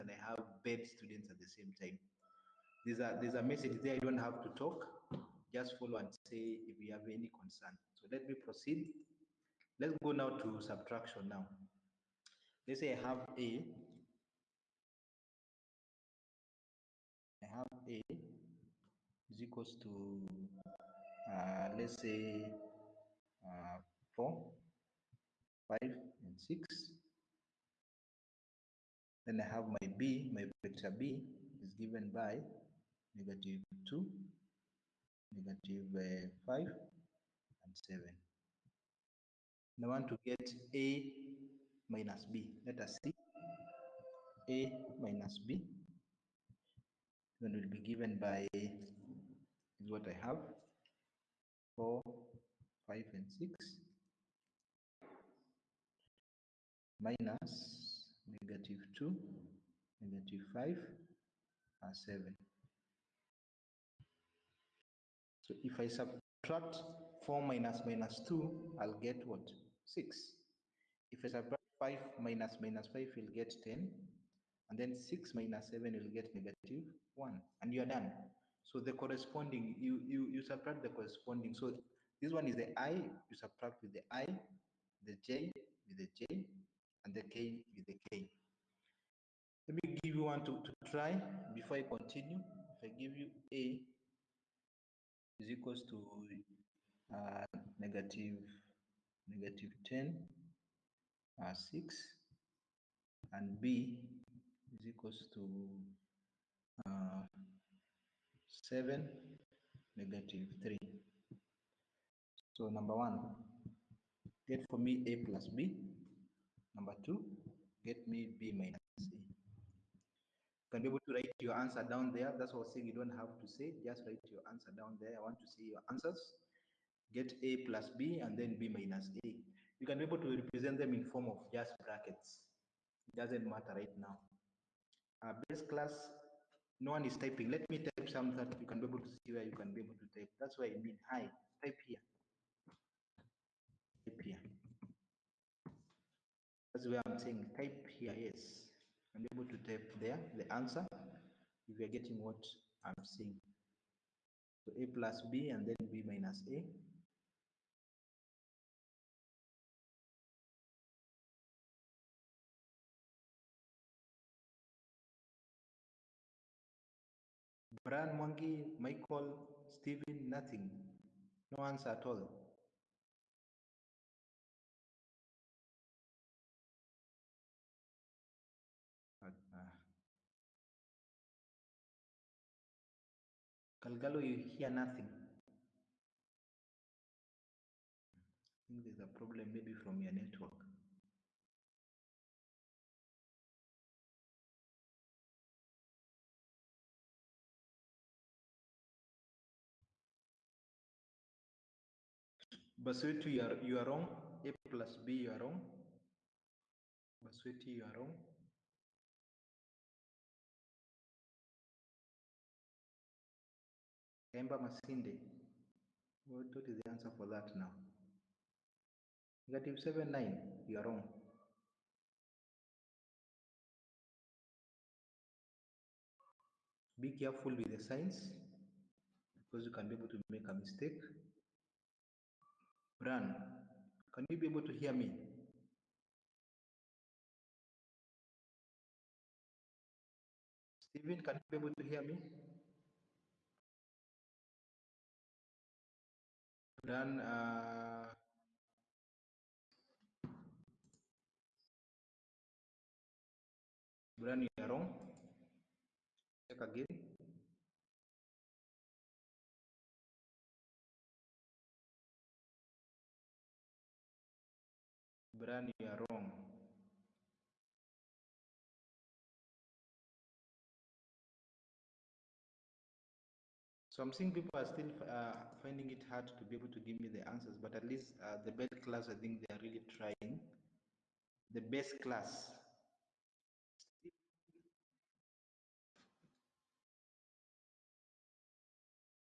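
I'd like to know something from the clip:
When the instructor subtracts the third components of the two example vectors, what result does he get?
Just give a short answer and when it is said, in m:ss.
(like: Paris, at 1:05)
-1, at 1:16.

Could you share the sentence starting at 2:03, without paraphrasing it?
Just write your answer down there.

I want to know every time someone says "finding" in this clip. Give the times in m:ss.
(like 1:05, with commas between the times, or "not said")
4:35.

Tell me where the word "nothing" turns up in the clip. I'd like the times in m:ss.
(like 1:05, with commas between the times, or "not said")
2:50, 3:04.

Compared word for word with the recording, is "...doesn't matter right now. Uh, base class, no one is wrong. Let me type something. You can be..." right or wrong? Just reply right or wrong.
wrong.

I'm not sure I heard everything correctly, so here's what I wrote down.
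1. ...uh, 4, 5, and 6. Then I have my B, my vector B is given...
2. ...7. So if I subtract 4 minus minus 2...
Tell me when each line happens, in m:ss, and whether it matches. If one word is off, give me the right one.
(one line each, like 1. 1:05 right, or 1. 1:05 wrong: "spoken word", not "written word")
1. 0:23 right
2. 1:01 right.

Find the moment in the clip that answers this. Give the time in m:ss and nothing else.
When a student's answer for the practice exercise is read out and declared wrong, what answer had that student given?
3:39.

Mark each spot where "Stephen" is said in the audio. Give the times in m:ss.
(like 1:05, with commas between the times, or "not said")
2:49, 4:00.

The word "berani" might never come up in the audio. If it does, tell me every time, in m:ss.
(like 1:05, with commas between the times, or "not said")
4:16, 4:25.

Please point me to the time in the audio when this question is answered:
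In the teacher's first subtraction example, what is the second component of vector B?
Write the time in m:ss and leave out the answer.
0:35.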